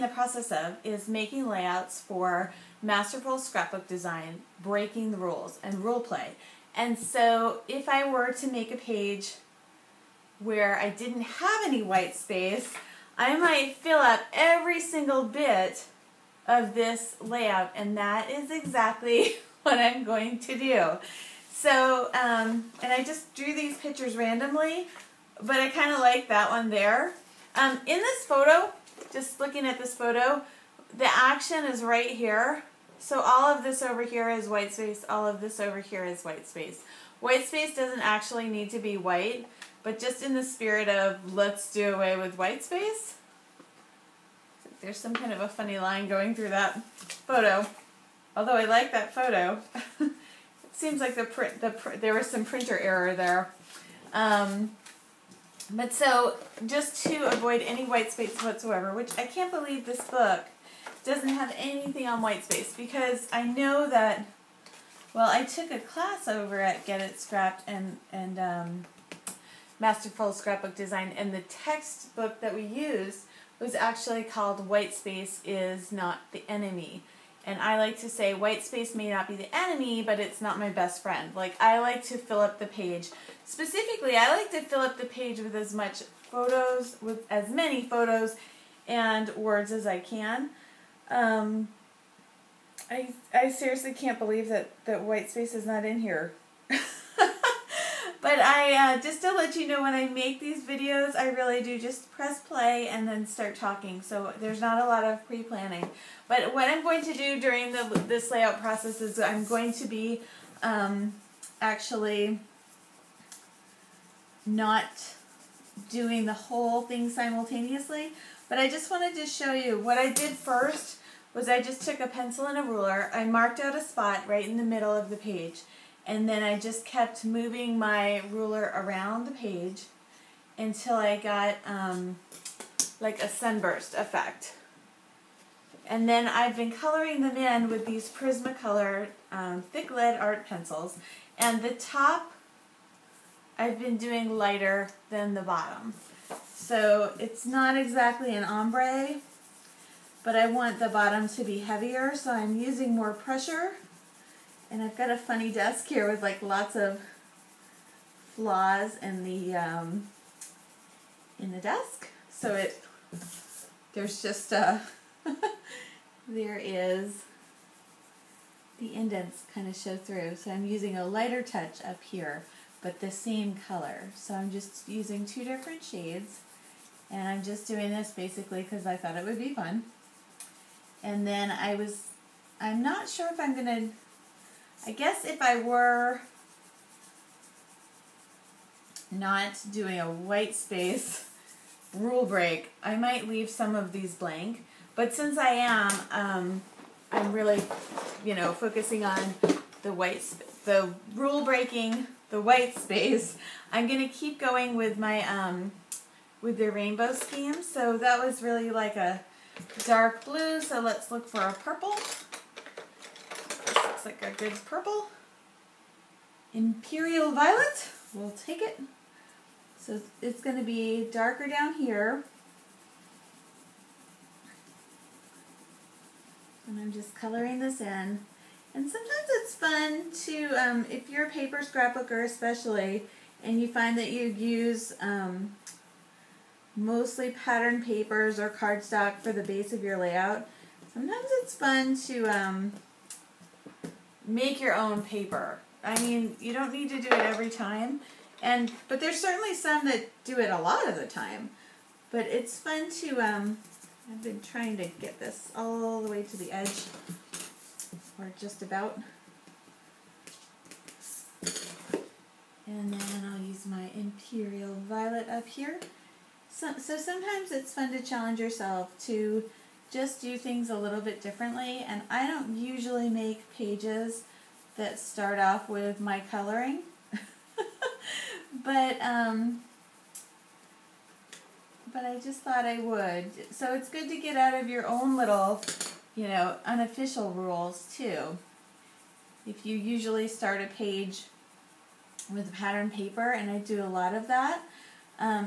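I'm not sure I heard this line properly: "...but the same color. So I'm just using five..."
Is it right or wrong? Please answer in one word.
wrong.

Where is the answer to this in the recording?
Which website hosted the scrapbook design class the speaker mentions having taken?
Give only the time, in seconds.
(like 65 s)
66 s.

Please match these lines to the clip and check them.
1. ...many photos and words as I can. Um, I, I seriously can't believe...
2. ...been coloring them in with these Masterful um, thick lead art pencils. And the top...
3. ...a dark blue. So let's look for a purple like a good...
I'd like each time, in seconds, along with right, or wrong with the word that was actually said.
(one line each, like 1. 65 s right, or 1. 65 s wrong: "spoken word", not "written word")
1. 87 s right
2. 136 s wrong: "Prismacolor", not "Masterful"
3. 208 s right.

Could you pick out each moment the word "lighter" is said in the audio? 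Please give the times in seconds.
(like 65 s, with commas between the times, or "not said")
144 s, 171 s.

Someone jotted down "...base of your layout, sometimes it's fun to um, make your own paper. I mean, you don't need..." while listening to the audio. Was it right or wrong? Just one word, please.
right.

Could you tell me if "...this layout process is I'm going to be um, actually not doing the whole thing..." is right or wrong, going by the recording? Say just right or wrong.
right.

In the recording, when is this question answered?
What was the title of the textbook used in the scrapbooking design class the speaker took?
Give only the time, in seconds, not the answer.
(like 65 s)
74 s.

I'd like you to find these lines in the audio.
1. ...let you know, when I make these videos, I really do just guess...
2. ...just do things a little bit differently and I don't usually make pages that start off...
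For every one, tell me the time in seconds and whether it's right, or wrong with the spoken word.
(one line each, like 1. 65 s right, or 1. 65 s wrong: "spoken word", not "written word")
1. 99 s wrong: "press", not "guess"
2. 269 s right.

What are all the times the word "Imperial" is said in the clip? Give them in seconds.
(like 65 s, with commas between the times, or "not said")
216 s, 263 s.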